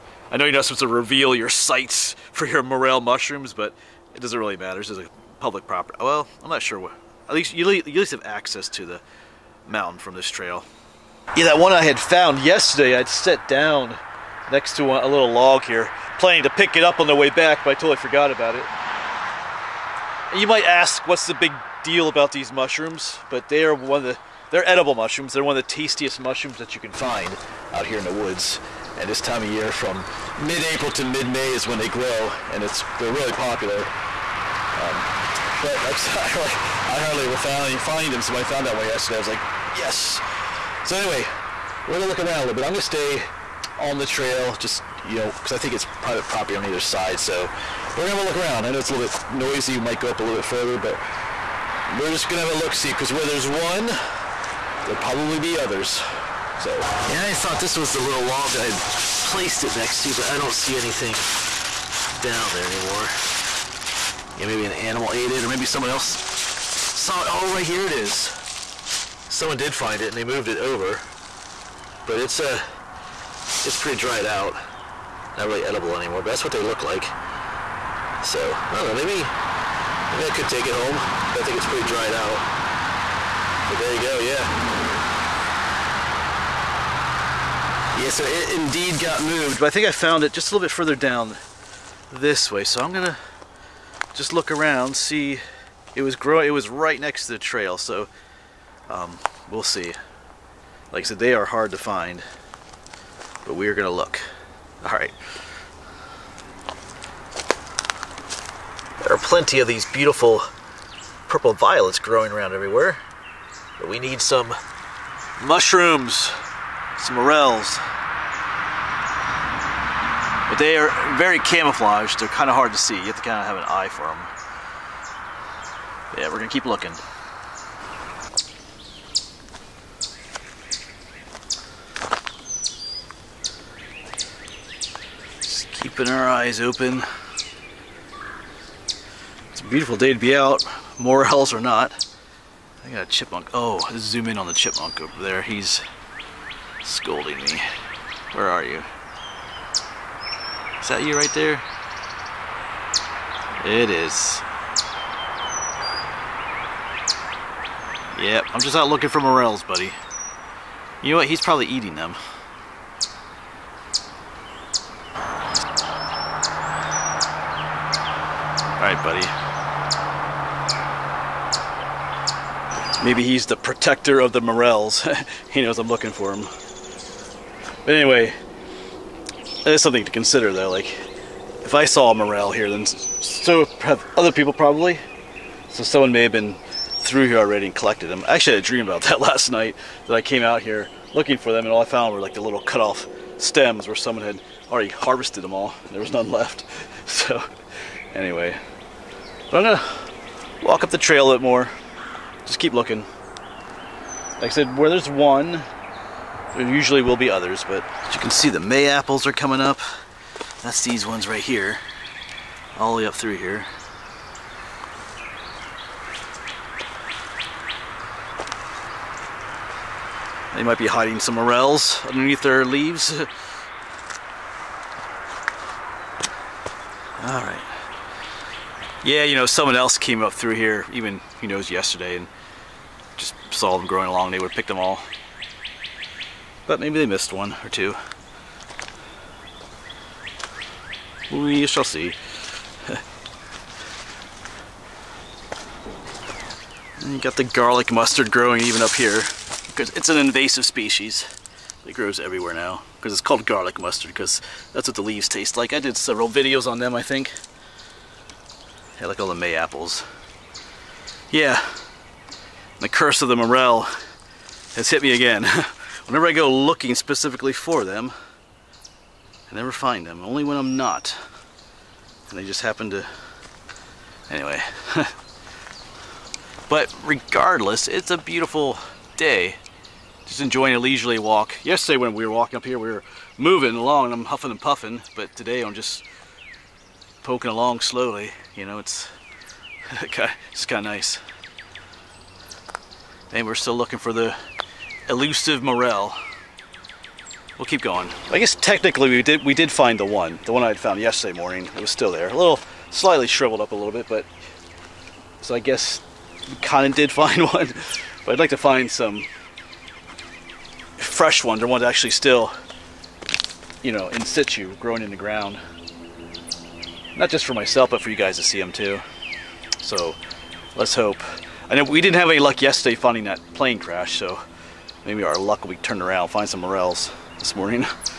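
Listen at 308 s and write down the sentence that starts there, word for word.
But I'd like to find some fresh ones, or ones actually still, you know, in situ, growing in the ground.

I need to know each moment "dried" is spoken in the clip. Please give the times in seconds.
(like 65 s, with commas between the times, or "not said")
73 s, 81 s.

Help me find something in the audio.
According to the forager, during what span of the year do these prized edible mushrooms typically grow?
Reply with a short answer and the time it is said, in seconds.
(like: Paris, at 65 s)
mid-April to mid-May, at 30 s.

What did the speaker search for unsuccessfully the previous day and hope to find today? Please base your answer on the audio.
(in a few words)
plane crash.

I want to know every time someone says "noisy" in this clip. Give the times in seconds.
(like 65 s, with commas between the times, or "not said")
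49 s.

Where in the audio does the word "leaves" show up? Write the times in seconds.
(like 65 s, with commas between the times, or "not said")
222 s, 255 s.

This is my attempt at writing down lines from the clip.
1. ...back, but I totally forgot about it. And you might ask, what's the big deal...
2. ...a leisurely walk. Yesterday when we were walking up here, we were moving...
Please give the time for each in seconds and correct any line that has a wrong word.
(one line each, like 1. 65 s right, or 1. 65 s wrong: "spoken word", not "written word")
1. 17 s right
2. 280 s right.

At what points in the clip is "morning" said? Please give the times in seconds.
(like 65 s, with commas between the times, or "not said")
301 s, 327 s.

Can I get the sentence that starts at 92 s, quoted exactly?
So I'm gonna just look around, see, it was growing, it was right next to the trail, so um, we'll see.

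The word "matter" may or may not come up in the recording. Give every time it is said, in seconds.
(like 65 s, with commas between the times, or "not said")
4 s.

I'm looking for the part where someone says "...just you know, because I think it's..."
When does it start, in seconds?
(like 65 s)
44 s.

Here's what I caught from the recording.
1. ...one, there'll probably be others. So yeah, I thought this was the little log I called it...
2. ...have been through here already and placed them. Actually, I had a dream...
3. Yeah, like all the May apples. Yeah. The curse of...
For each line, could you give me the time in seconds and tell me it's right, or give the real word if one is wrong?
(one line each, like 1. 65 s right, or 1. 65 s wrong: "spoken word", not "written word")
1. 53 s wrong: "placed", not "called"
2. 186 s wrong: "collected", not "placed"
3. 258 s right.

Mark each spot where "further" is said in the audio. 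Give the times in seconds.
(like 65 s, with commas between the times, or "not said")
50 s, 90 s.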